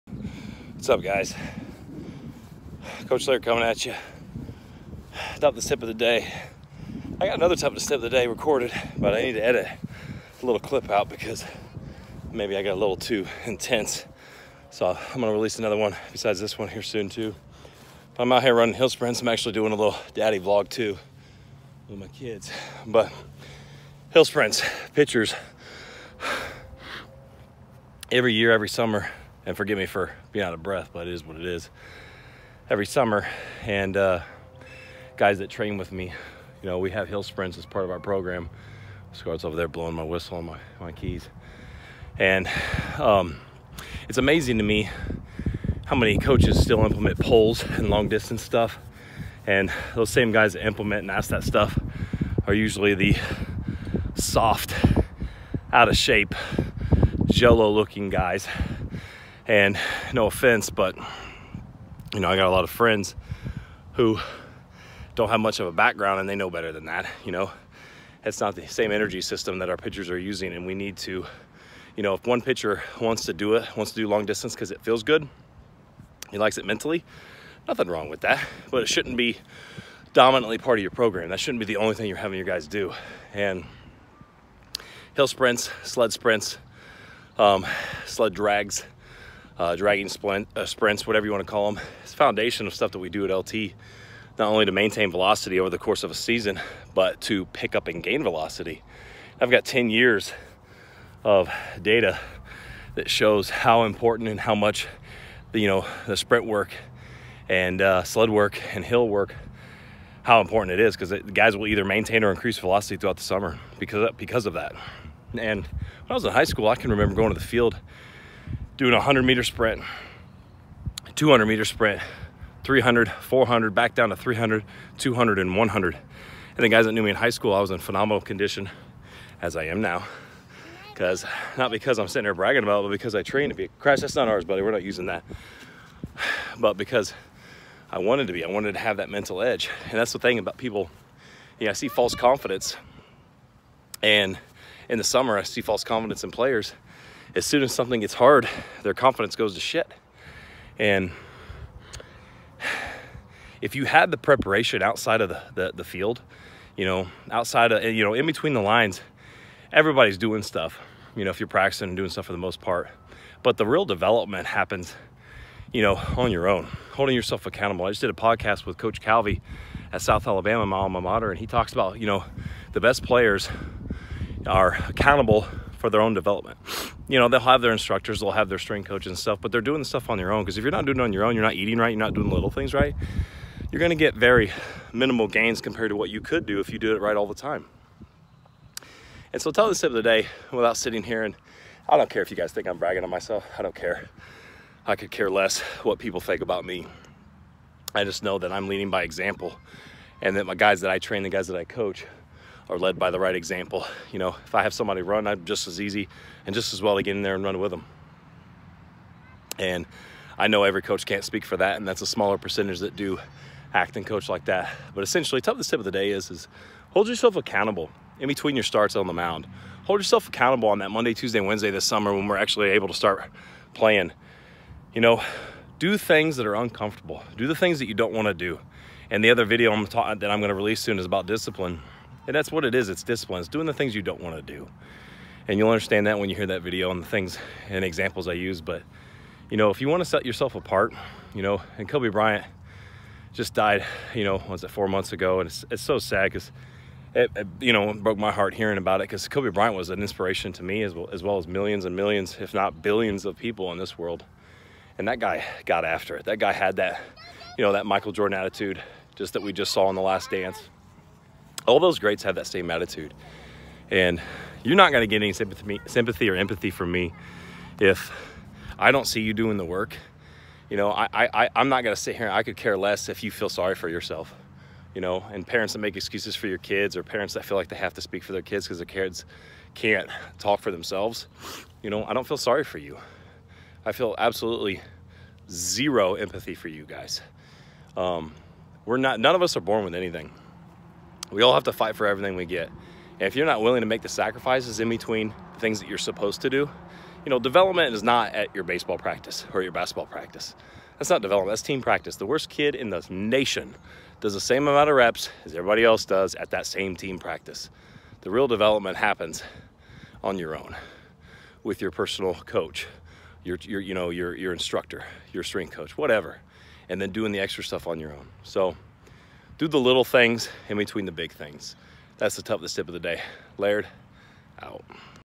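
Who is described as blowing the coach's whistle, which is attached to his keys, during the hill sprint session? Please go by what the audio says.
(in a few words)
Scott.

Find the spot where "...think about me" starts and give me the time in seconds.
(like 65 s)
196 s.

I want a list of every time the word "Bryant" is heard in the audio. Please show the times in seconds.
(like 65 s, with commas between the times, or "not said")
242 s, 249 s.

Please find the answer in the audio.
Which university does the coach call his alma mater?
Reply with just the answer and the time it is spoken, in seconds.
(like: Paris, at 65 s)
South Alabama, at 170 s.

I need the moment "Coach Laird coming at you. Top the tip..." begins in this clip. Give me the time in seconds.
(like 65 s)
3 s.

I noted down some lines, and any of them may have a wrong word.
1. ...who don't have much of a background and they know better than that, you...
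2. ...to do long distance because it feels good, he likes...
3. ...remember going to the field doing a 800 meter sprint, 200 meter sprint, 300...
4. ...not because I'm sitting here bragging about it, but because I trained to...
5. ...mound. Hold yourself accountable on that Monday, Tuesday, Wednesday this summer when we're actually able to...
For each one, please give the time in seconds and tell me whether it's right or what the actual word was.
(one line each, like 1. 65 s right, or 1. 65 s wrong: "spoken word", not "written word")
1. 63 s right
2. 73 s right
3. 116 s wrong: "100", not "800"
4. 131 s right
5. 219 s right.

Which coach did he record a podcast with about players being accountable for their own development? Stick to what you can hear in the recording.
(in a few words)
Coach Calvi.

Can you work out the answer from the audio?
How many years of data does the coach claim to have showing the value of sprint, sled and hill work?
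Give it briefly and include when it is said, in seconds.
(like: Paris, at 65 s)
10, at 99 s.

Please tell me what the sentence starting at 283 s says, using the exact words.
I feel absolutely zero empathy for you guys.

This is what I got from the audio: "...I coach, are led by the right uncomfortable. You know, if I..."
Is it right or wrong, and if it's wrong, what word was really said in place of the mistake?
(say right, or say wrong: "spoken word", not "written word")
wrong: "example", not "uncomfortable".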